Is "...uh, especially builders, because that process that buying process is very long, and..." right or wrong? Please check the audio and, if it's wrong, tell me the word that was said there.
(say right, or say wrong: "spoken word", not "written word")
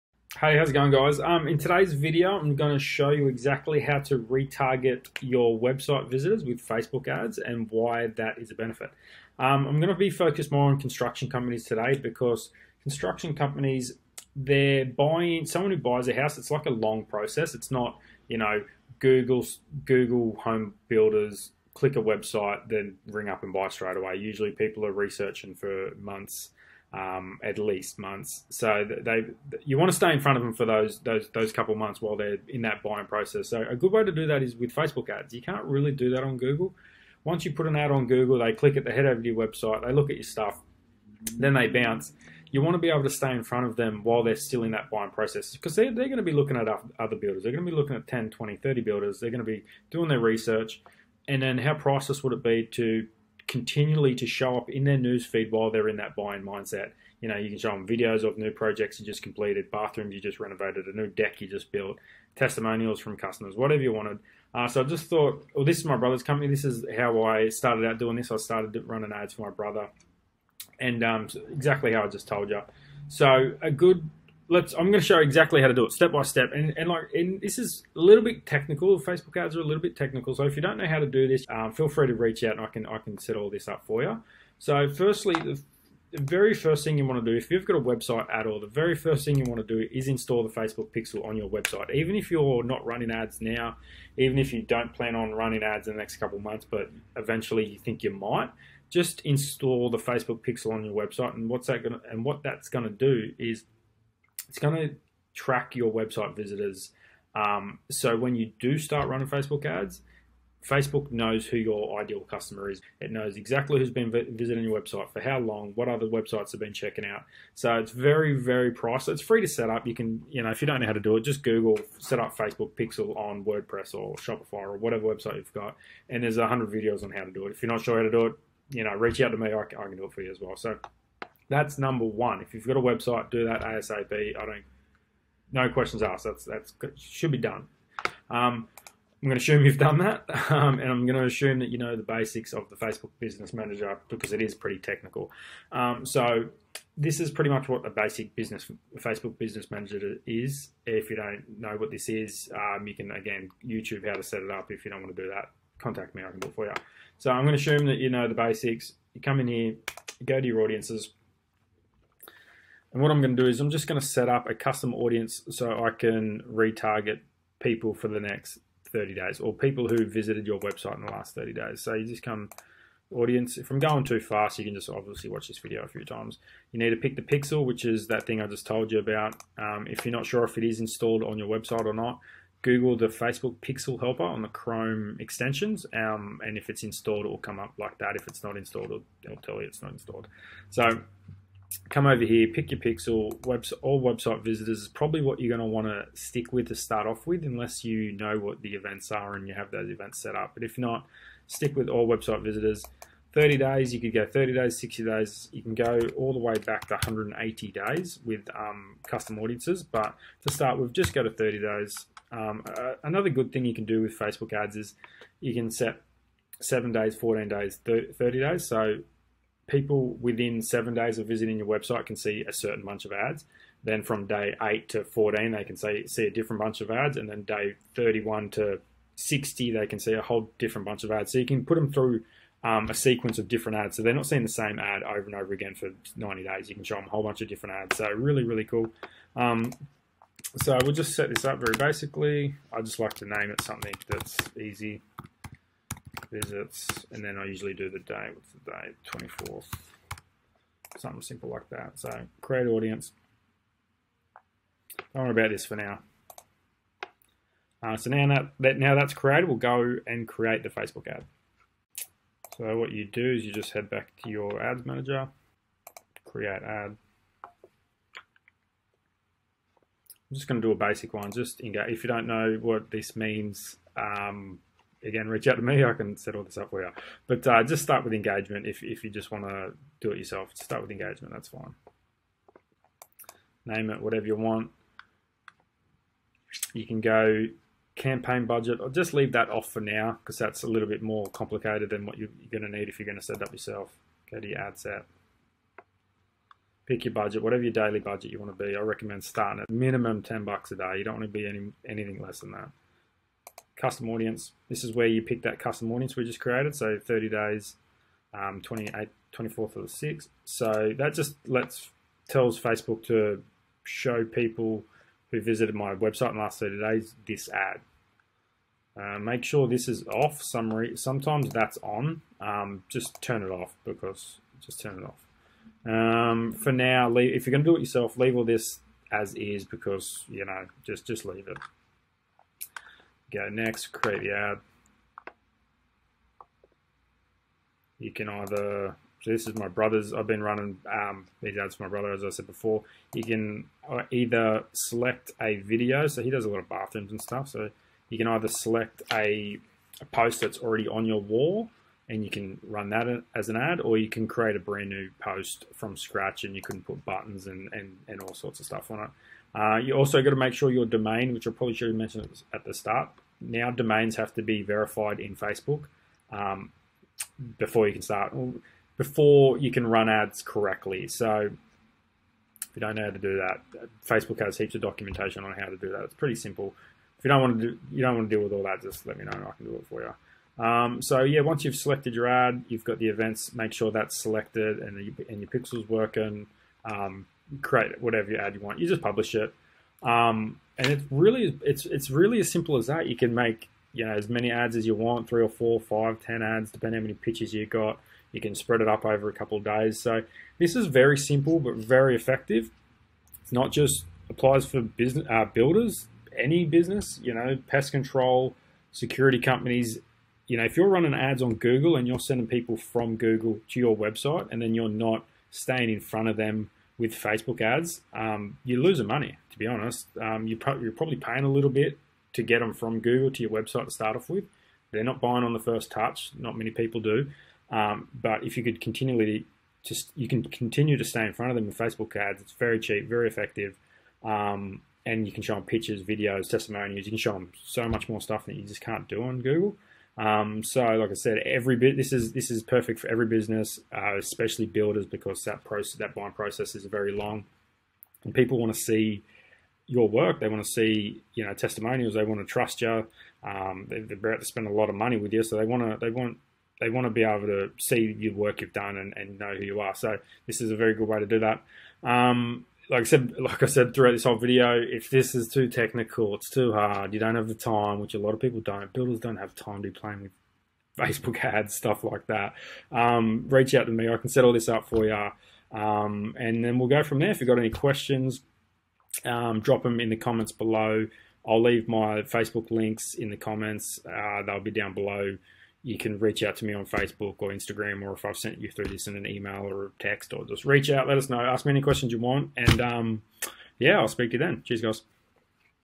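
right.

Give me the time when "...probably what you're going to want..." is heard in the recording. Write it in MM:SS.
03:14.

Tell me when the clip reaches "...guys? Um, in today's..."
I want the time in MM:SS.
00:00.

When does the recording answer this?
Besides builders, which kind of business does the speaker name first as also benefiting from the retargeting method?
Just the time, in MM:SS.
06:47.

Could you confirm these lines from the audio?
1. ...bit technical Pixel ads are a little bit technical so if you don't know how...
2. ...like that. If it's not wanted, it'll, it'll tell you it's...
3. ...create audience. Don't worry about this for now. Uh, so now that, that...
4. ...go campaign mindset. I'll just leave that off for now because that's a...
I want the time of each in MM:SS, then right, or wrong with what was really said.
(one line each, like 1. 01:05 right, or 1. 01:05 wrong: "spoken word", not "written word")
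1. 01:18 wrong: "Facebook", not "Pixel"
2. 03:07 wrong: "installed", not "wanted"
3. 04:12 right
4. 04:47 wrong: "budget", not "mindset".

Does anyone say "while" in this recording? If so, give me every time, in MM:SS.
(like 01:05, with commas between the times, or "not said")
00:32, 00:44, 00:55.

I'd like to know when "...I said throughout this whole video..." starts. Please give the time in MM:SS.
07:43.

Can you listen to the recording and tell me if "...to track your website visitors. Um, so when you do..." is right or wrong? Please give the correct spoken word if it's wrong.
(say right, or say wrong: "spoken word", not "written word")
right.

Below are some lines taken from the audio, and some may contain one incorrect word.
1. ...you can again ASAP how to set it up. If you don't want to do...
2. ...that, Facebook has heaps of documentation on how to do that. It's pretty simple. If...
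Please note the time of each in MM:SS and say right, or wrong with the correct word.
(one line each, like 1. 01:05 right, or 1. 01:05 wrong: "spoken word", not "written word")
1. 02:32 wrong: "YouTube", not "ASAP"
2. 06:13 right.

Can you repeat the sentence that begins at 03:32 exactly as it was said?
Um, uh, another good thing you can do with Facebook ads is you can set 7 days, 14 days, 30 days.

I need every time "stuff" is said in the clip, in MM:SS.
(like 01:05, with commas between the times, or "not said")
00:40, 05:47, 05:58, 07:18, 07:51.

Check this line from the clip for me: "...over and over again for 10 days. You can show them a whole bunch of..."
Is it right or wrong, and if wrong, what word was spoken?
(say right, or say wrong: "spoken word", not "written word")
wrong: "90", not "10".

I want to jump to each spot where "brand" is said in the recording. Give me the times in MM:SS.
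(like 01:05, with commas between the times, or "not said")
05:54.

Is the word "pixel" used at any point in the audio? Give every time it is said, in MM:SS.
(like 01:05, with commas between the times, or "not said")
01:30, 01:40, 02:02, 02:57, 03:03, 03:12, 06:25.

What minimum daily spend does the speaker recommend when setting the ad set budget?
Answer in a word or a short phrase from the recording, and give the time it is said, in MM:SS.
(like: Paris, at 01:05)
10 bucks a day, at 05:00.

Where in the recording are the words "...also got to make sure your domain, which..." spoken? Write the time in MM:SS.
05:59.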